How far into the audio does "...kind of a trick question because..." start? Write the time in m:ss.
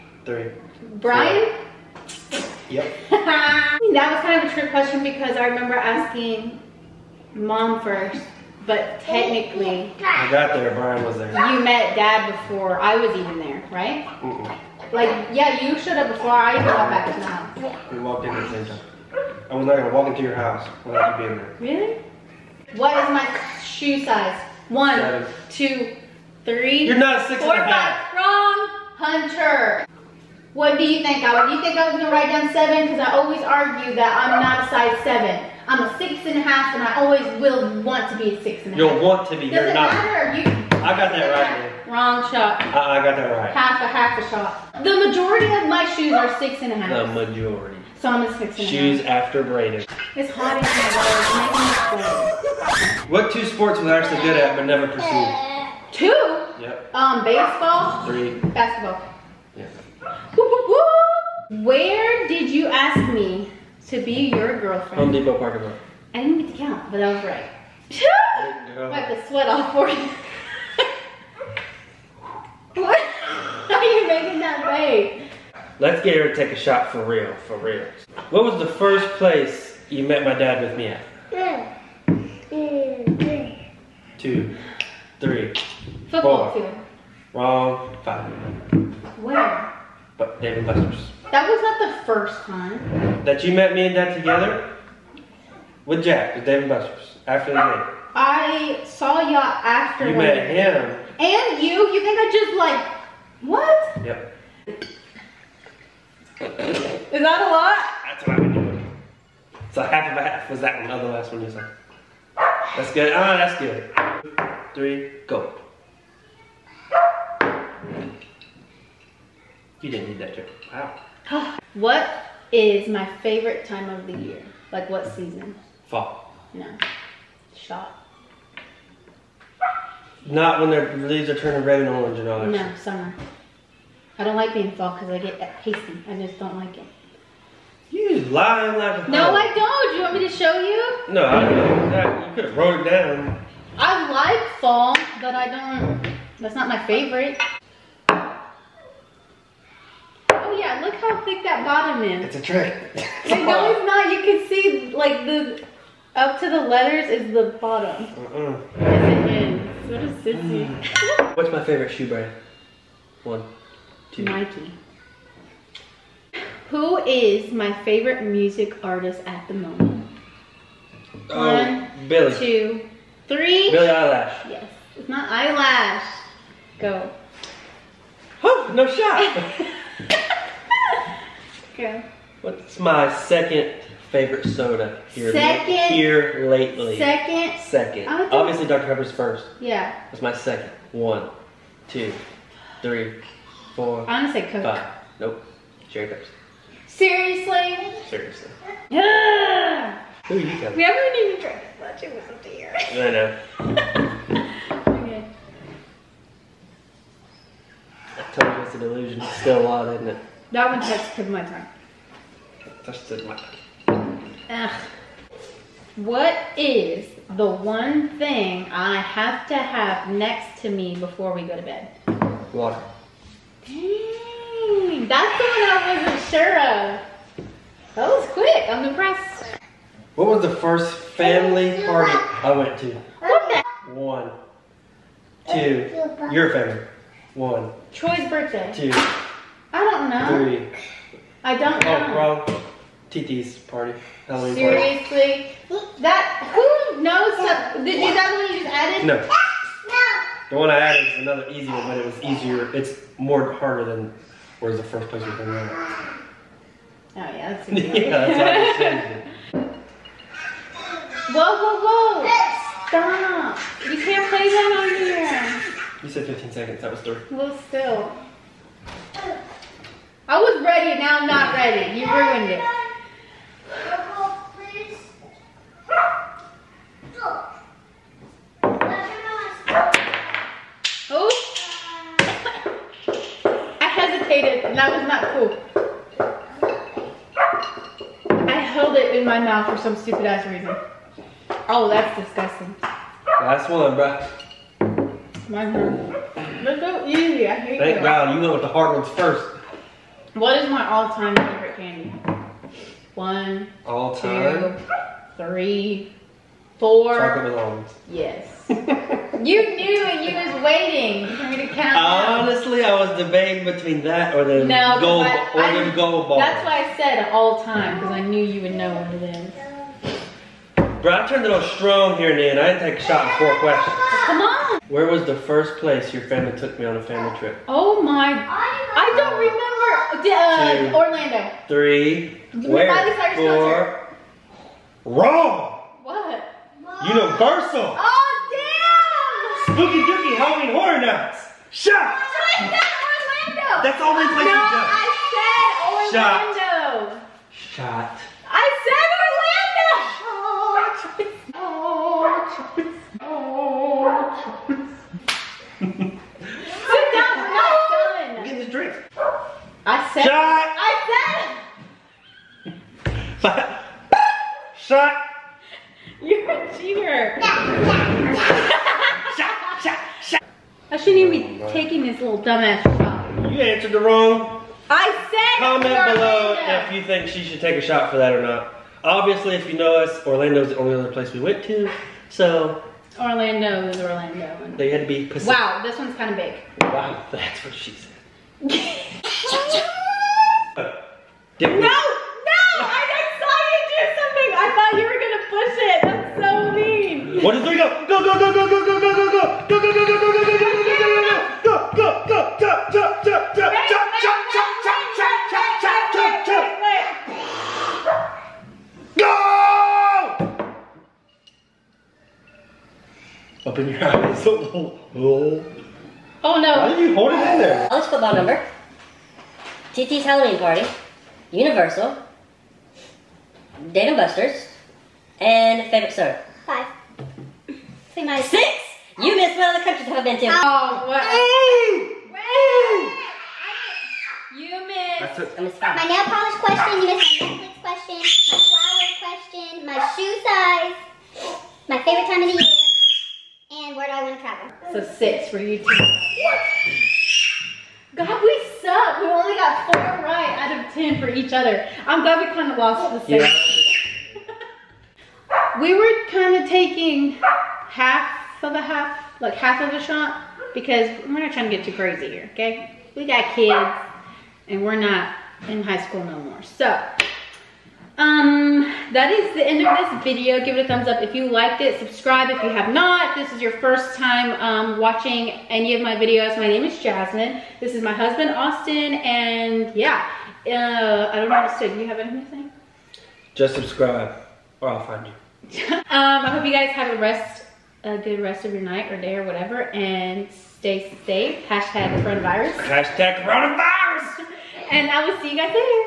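0:04.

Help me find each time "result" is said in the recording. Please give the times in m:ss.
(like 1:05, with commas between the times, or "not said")
not said.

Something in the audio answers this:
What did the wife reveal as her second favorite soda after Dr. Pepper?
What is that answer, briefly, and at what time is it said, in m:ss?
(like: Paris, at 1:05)
Cherry Pepsi, at 3:15.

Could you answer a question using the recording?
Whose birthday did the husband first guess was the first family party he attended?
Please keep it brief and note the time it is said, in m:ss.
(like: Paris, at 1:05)
Troy's birthday, at 3:57.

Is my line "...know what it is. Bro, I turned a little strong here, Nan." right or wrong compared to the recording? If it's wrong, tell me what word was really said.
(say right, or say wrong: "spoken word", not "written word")
right.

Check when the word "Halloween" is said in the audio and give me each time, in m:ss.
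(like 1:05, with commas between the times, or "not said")
4:04, 5:40, 7:00.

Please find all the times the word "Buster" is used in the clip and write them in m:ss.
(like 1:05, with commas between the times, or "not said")
1:30, 1:36, 7:04.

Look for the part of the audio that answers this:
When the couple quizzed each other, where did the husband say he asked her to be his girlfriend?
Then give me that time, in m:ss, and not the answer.
1:04.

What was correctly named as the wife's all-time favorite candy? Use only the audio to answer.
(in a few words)
Chocolate melons.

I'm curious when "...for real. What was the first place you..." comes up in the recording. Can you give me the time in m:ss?
1:17.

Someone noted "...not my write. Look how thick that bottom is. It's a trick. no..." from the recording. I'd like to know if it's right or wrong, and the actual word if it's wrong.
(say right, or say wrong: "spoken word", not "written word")
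wrong: "favorite", not "write".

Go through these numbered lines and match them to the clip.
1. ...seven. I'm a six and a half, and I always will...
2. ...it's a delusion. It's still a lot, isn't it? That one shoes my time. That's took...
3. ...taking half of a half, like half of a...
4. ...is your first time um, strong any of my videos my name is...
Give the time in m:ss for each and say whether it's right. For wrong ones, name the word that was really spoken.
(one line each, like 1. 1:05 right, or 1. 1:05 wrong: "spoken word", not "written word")
1. 0:35 right
2. 3:28 wrong: "takes", not "shoes"
3. 7:36 right
4. 7:53 wrong: "watching", not "strong".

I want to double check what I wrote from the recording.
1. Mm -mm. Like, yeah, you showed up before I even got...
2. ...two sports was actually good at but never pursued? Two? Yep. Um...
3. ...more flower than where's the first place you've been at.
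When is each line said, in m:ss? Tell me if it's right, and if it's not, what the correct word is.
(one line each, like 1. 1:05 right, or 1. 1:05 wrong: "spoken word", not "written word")
1. 0:14 right
2. 0:53 right
3. 4:13 wrong: "harder", not "flower".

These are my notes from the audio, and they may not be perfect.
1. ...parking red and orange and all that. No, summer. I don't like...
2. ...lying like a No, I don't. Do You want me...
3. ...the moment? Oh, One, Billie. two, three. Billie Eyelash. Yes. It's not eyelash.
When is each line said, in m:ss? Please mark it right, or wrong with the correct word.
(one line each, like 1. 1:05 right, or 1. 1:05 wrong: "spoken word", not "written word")
1. 2:11 wrong: "turning", not "parking"
2. 2:18 right
3. 2:49 right.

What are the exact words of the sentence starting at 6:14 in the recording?
I said Comment below if you think she should take a shot for that or not.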